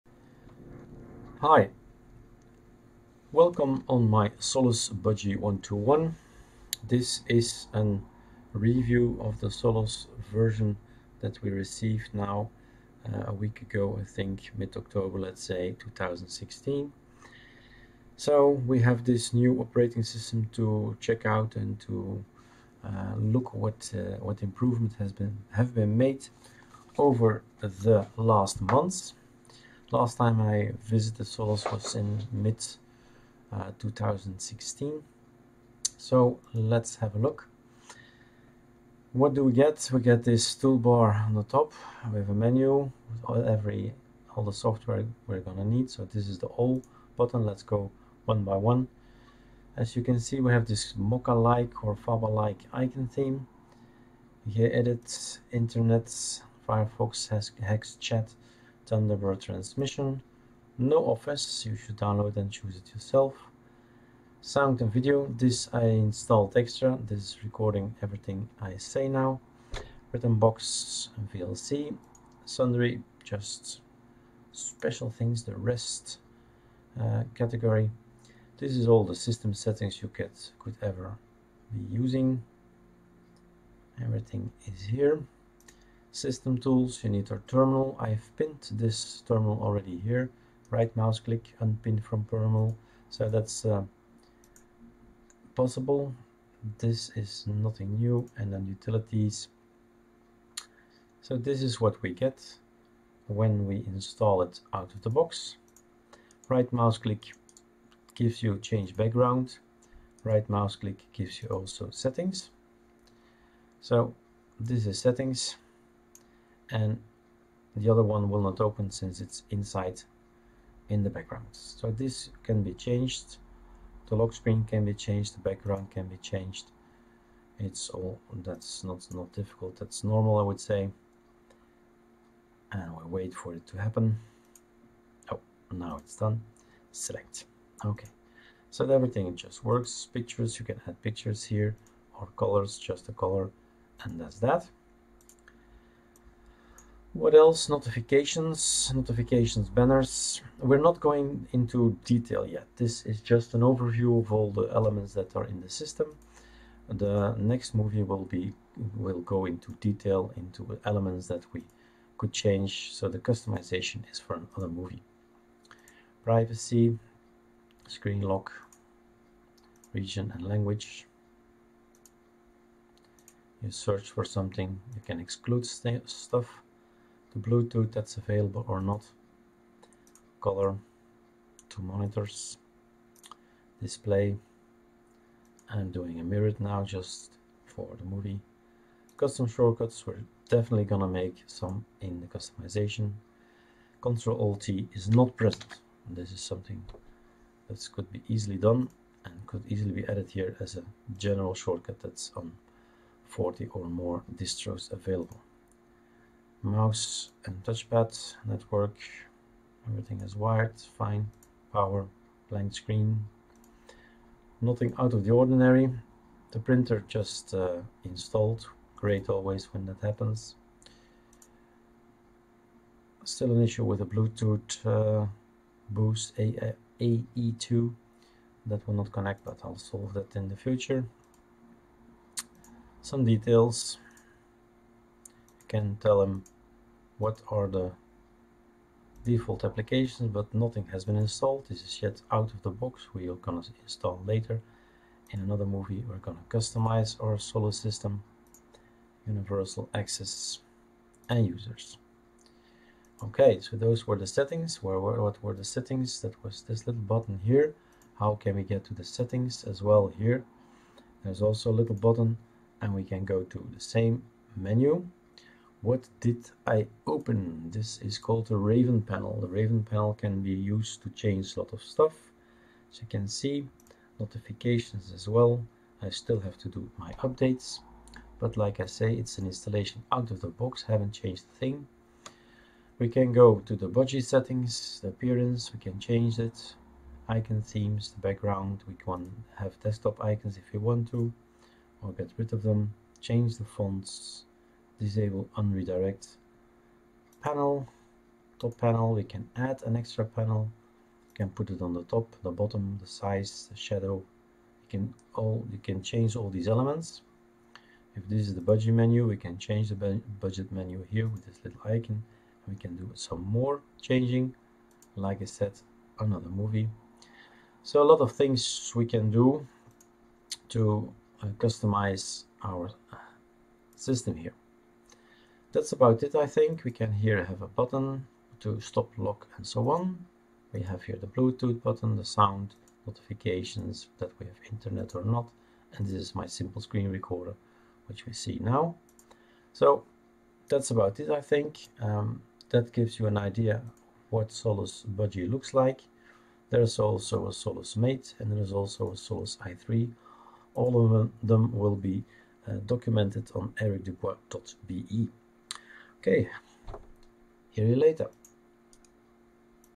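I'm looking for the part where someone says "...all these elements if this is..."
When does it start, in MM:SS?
05:06.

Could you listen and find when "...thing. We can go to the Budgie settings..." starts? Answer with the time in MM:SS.
04:41.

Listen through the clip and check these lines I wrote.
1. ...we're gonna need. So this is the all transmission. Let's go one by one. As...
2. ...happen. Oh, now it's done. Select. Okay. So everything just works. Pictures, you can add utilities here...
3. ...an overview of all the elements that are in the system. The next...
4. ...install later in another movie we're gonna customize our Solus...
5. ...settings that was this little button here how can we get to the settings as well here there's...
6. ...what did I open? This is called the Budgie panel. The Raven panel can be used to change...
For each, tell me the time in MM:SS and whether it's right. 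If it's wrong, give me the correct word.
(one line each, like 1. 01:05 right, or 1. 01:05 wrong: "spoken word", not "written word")
1. 00:45 wrong: "button", not "transmission"
2. 02:13 wrong: "pictures", not "utilities"
3. 02:33 right
4. 04:03 right
5. 04:15 right
6. 04:25 wrong: "Raven", not "Budgie".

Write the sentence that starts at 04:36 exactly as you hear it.
I still have to do my updates.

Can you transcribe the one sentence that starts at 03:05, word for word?
I'm doing a mirror now just for the movie.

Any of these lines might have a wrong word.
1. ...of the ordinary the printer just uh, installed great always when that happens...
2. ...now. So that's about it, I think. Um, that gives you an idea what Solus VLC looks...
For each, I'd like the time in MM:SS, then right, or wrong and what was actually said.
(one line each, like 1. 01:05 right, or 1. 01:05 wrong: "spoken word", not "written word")
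1. 03:35 right
2. 05:38 wrong: "Budgie", not "VLC".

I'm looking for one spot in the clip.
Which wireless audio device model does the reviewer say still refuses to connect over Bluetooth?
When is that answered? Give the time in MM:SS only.
03:45.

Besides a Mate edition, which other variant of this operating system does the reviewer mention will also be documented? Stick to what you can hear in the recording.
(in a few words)
Solus i3.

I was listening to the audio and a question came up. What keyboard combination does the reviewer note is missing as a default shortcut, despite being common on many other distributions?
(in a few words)
Control Alt T.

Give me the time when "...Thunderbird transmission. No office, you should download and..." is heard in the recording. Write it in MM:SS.
00:58.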